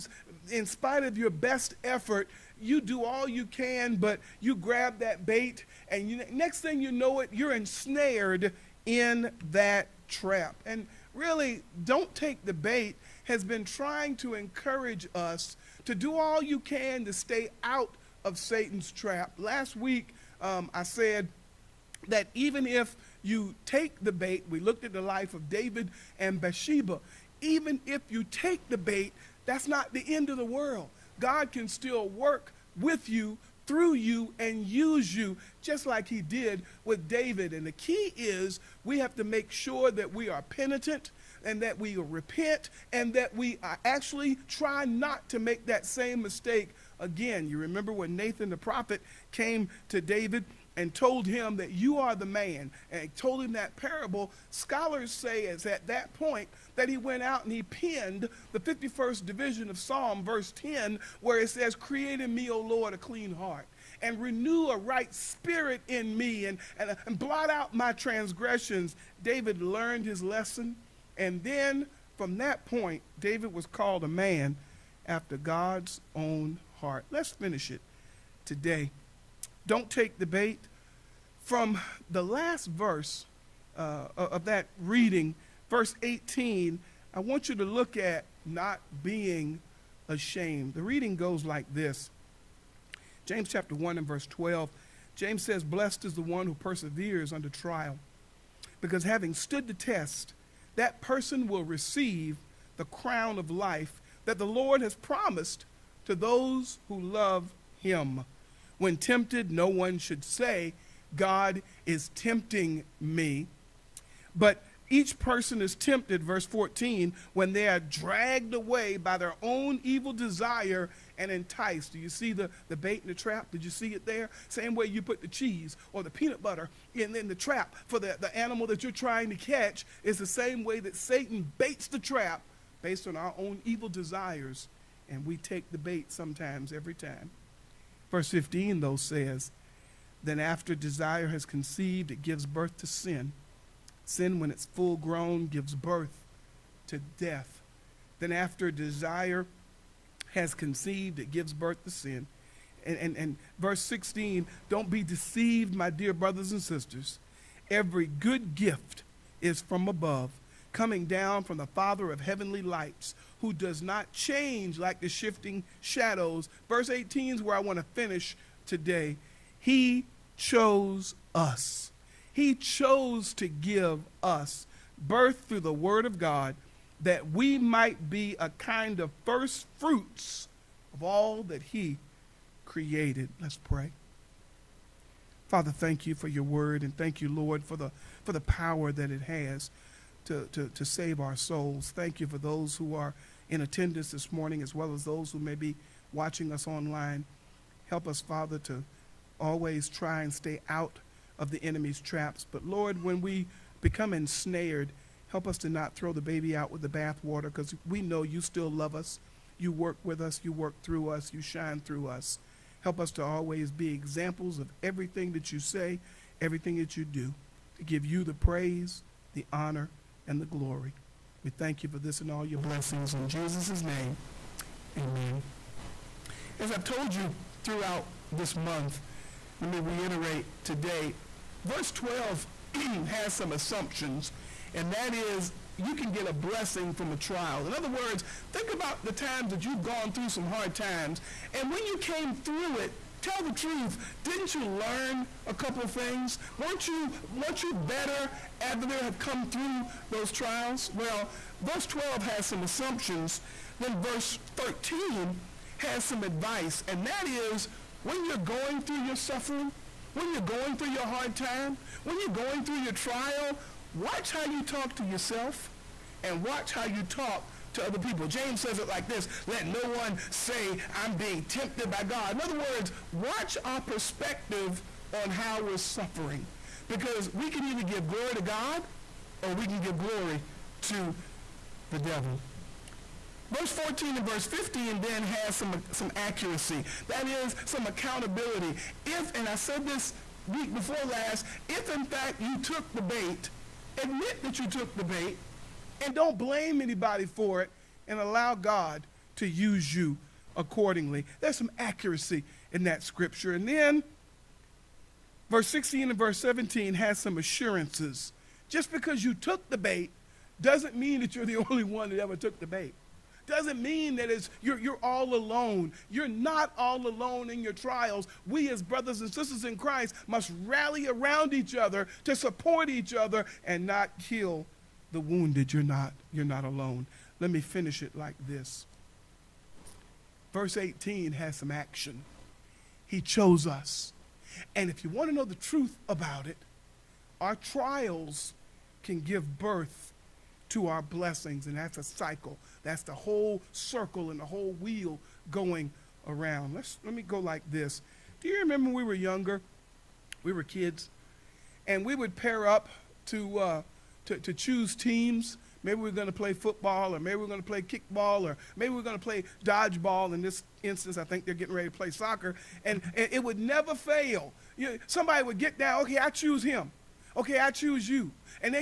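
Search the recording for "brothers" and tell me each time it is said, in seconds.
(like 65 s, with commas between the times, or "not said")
156 s, 318 s.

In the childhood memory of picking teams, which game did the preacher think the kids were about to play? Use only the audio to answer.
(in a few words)
soccer.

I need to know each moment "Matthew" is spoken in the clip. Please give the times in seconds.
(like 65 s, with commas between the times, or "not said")
not said.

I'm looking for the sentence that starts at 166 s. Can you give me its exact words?
Verse 18 is where I want to finish today.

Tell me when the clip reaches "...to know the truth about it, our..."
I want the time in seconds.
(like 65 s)
335 s.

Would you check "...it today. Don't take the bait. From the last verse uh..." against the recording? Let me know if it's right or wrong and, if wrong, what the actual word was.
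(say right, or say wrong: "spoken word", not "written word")
right.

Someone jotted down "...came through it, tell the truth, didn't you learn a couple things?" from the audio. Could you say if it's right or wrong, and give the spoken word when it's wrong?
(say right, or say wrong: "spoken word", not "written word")
right.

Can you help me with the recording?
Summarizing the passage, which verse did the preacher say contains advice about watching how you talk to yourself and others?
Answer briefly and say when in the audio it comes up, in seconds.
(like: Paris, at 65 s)
verse 13, at 253 s.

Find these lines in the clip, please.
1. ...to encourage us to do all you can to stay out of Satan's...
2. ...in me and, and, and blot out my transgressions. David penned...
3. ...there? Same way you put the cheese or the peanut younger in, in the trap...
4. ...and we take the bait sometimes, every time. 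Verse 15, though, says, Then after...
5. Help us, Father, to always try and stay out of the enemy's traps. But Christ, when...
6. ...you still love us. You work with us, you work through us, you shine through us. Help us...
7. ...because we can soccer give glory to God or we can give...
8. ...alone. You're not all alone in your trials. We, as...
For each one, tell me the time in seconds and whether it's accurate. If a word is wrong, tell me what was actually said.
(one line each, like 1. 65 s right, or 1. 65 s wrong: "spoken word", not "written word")
1. 14 s right
2. 65 s wrong: "learned", not "penned"
3. 124 s wrong: "butter", not "younger"
4. 135 s right
5. 197 s wrong: "Lord", not "Christ"
6. 208 s right
7. 276 s wrong: "either", not "soccer"
8. 315 s right.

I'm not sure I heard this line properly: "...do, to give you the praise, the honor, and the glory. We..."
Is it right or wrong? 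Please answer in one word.
right.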